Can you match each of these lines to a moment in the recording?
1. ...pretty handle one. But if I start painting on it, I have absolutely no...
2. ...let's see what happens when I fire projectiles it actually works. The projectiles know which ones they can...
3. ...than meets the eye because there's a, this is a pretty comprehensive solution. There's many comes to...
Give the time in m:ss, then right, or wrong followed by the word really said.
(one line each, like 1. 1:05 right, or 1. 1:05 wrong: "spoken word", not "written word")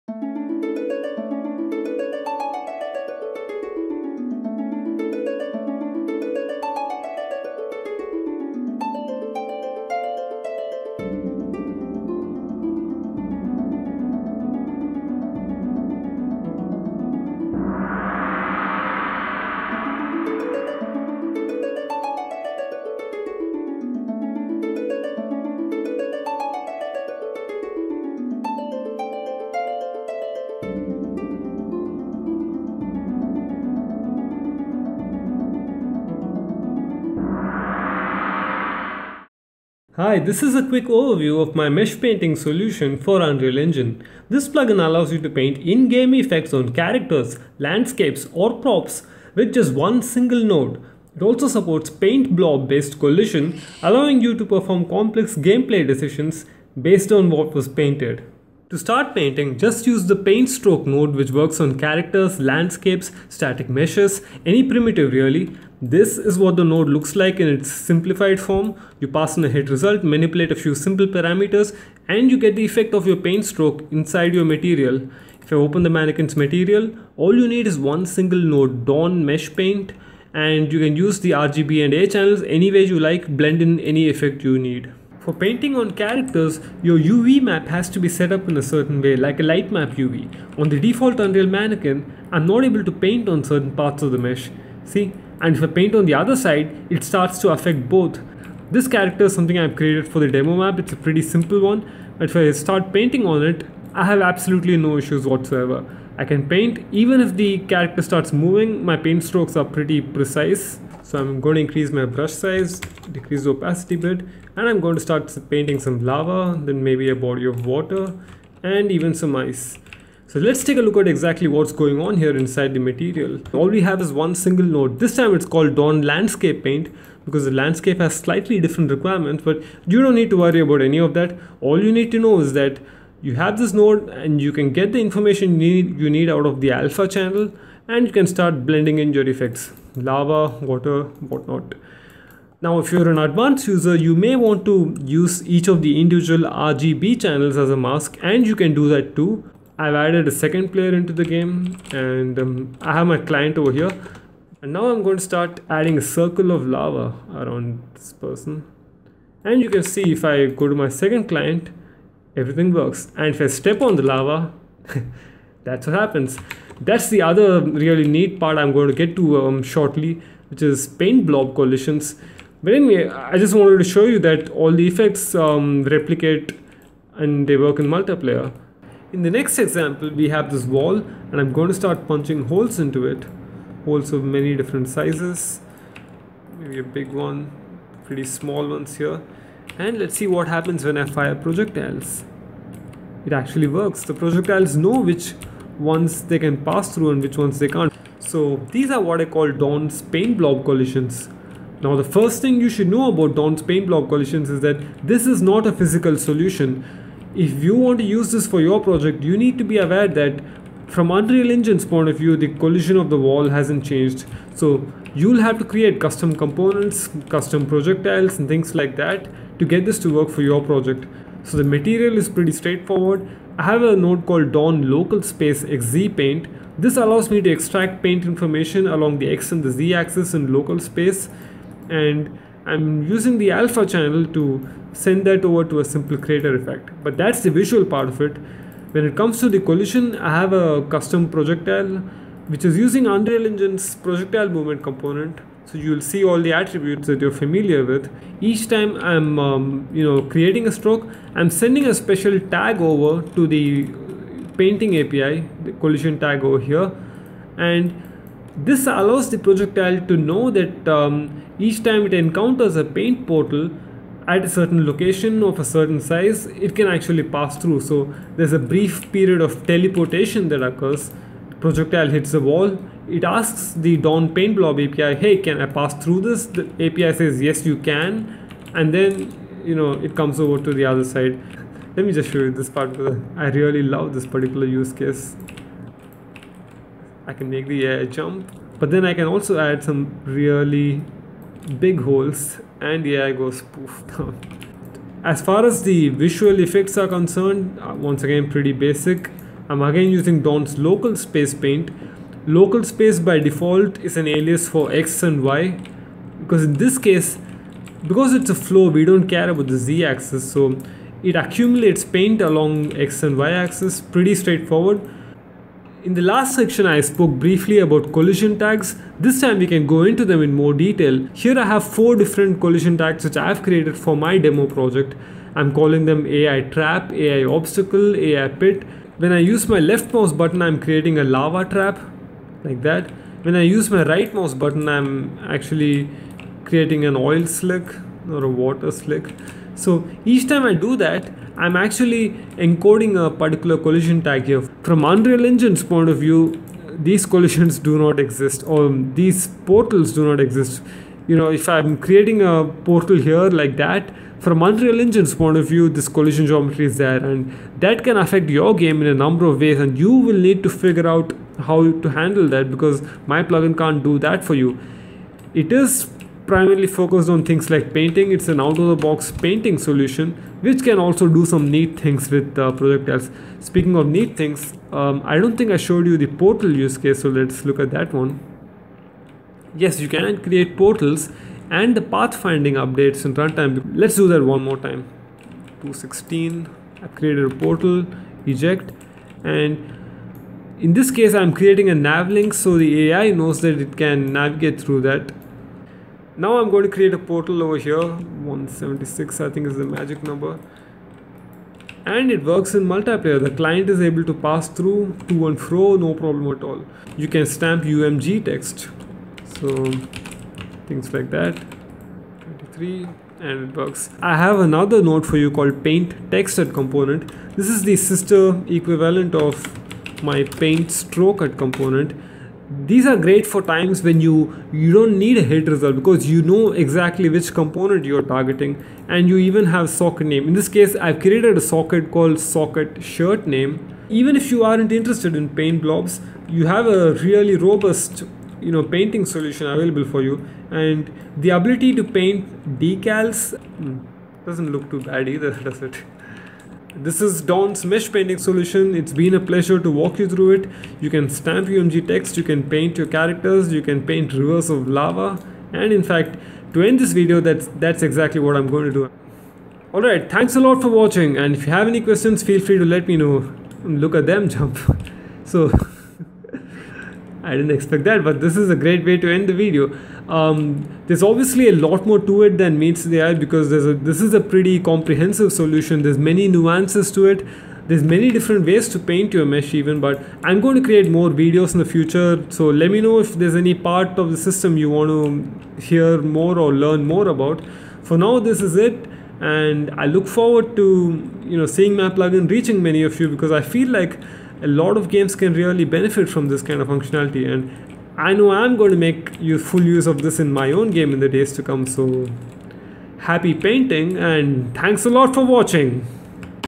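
1. 1:40 wrong: "simple", not "handle"
2. 3:09 right
3. 7:52 wrong: "nuances", not "comes".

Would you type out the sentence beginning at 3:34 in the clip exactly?
So you'll have to create custom components, custom projectiles and things like that to get this to work for your project.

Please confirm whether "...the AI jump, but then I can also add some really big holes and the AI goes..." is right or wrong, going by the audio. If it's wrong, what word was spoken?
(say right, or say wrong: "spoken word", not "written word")
right.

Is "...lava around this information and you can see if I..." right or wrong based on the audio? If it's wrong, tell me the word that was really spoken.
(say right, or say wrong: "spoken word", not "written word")
wrong: "person", not "information".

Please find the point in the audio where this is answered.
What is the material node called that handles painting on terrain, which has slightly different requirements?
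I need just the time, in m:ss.
2:05.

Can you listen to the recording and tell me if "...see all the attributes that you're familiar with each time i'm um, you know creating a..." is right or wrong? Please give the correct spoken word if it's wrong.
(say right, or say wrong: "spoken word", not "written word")
right.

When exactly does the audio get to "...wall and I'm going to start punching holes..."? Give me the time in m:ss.
3:00.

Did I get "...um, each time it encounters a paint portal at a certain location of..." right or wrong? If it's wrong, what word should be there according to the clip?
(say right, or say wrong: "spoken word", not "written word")
right.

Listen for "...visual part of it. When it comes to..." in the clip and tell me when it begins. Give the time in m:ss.
3:57.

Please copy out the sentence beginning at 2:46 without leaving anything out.
That's the other really neat part I'm going to get to um, shortly, which is paint blob collisions.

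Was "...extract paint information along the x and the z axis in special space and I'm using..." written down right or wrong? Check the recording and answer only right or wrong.
wrong.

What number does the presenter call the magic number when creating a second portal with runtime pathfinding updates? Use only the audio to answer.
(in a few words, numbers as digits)
176.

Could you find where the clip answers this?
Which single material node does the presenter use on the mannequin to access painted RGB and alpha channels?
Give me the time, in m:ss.
1:18.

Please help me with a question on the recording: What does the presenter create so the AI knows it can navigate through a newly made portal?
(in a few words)
a nav link.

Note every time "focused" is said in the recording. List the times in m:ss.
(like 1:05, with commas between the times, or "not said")
6:06.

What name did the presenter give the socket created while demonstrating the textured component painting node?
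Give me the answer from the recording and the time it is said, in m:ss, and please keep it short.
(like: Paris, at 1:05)
socket shirt, at 7:12.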